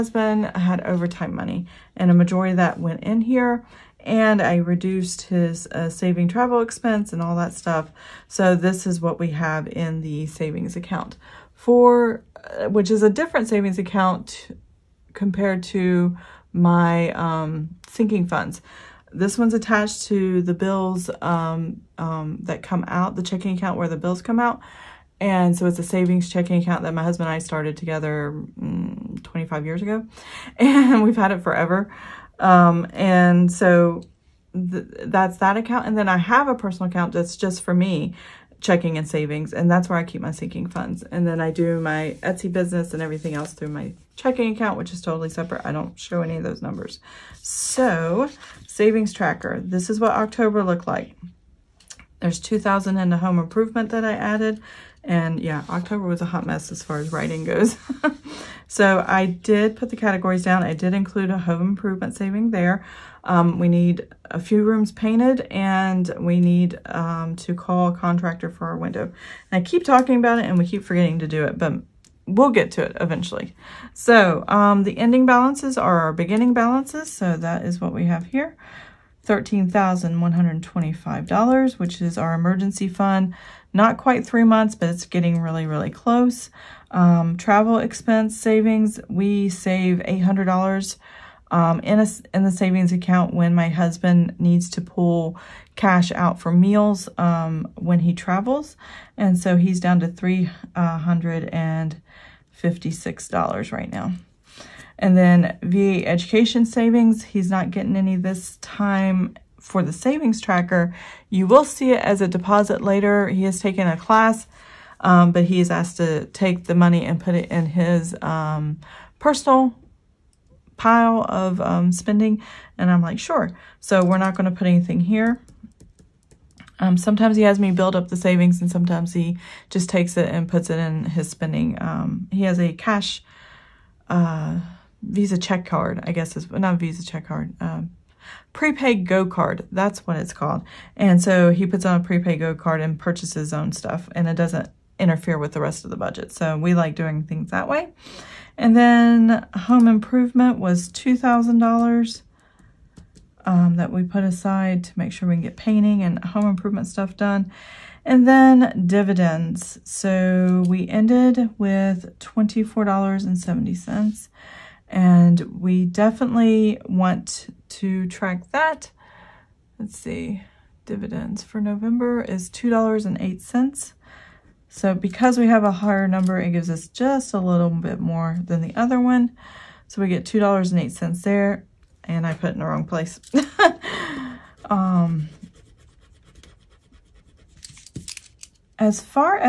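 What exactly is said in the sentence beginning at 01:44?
And then VA education savings, he's not getting any this time for the savings tracker.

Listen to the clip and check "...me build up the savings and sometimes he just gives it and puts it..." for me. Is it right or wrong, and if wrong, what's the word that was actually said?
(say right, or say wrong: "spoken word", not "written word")
wrong: "takes", not "gives".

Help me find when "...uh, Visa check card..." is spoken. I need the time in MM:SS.
02:14.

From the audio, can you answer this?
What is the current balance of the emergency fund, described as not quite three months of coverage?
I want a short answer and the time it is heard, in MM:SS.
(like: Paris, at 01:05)
$13,125, at 01:19.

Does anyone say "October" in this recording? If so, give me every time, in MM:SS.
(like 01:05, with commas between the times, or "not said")
00:50, 00:55.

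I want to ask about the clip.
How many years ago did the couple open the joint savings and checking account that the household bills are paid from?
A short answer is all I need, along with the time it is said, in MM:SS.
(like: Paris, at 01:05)
25, at 00:29.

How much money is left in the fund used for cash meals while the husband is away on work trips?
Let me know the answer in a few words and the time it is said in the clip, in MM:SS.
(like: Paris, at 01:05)
$356, at 01:40.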